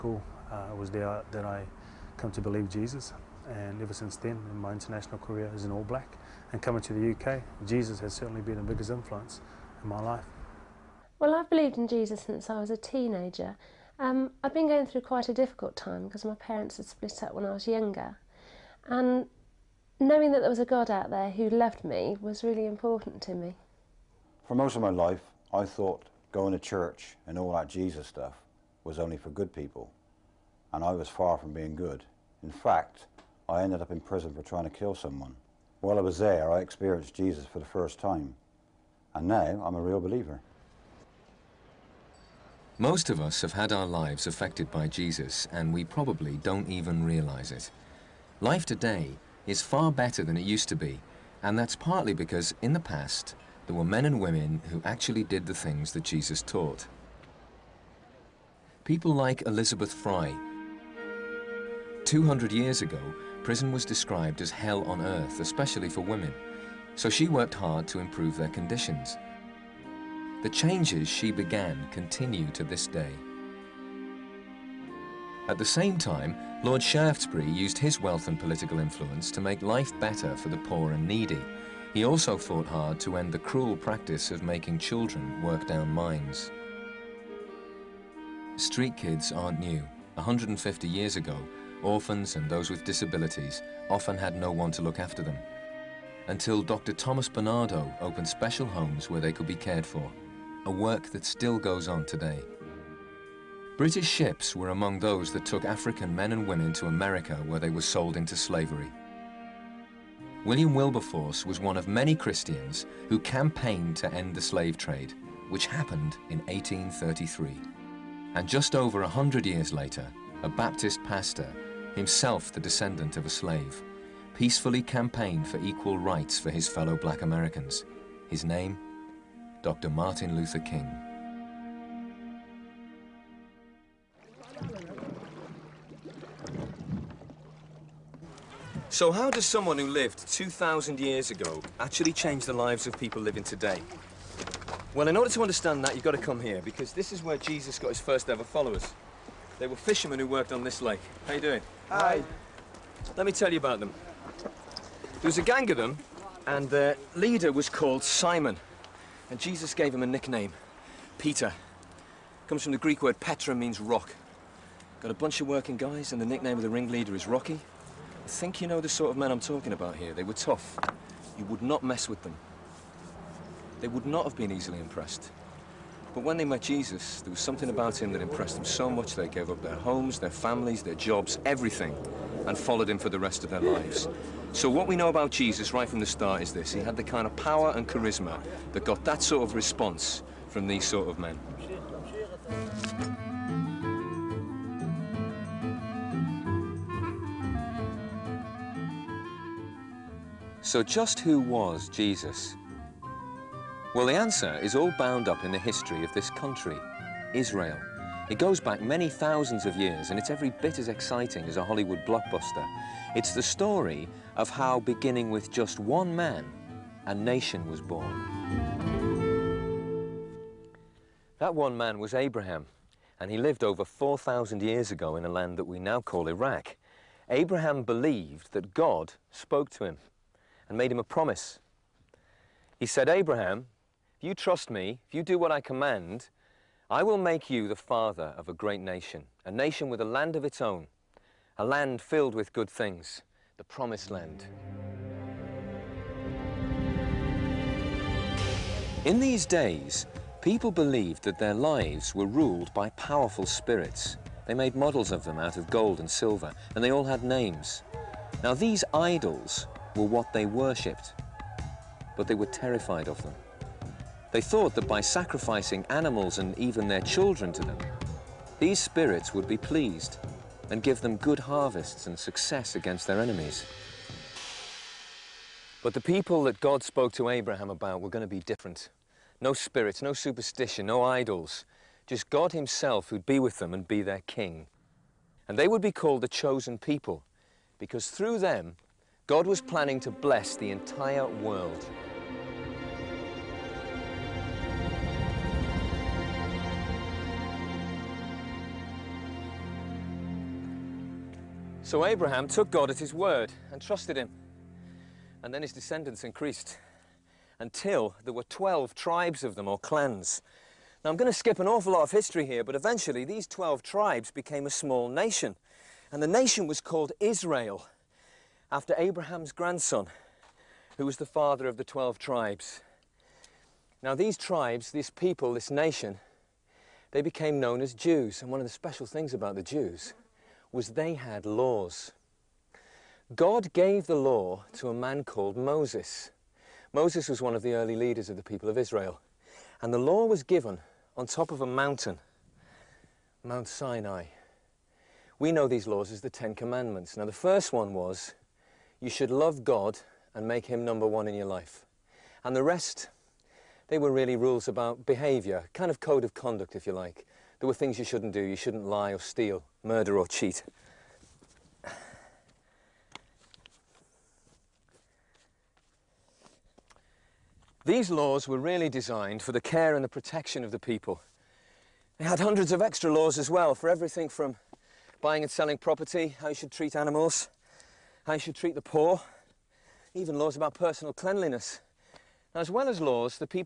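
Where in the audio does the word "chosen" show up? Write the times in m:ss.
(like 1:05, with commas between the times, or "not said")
4:46.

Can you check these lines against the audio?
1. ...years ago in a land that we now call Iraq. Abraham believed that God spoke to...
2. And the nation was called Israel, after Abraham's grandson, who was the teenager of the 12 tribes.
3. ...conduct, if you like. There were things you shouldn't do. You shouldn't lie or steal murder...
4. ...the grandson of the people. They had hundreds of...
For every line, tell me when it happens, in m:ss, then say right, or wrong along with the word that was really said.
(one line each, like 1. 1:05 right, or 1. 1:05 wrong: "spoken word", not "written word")
1. 3:44 right
2. 5:16 wrong: "father", not "teenager"
3. 5:56 right
4. 6:10 wrong: "protection", not "grandson".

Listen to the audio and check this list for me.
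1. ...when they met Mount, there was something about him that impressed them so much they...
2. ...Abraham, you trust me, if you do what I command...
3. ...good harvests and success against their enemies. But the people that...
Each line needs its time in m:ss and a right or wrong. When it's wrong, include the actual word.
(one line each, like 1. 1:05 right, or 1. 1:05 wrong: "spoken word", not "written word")
1. 2:56 wrong: "Jesus", not "Mount"
2. 3:53 right
3. 4:31 right.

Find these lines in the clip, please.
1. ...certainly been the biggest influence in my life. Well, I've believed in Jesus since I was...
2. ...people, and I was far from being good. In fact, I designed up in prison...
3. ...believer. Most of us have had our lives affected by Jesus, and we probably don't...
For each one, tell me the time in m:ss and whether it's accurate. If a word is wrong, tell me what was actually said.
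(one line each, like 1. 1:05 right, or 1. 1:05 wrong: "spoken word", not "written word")
1. 0:08 right
2. 0:29 wrong: "ended", not "designed"
3. 0:40 right.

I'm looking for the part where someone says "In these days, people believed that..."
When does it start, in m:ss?
4:09.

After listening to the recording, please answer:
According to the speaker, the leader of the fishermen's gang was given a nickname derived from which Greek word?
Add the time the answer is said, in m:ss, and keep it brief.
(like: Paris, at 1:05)
Petra, at 2:43.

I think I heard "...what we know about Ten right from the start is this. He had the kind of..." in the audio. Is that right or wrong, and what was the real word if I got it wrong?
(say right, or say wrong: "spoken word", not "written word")
wrong: "Jesus", not "Ten".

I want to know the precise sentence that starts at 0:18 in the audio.
And knowing that there was a God out there who loved me was really important to me.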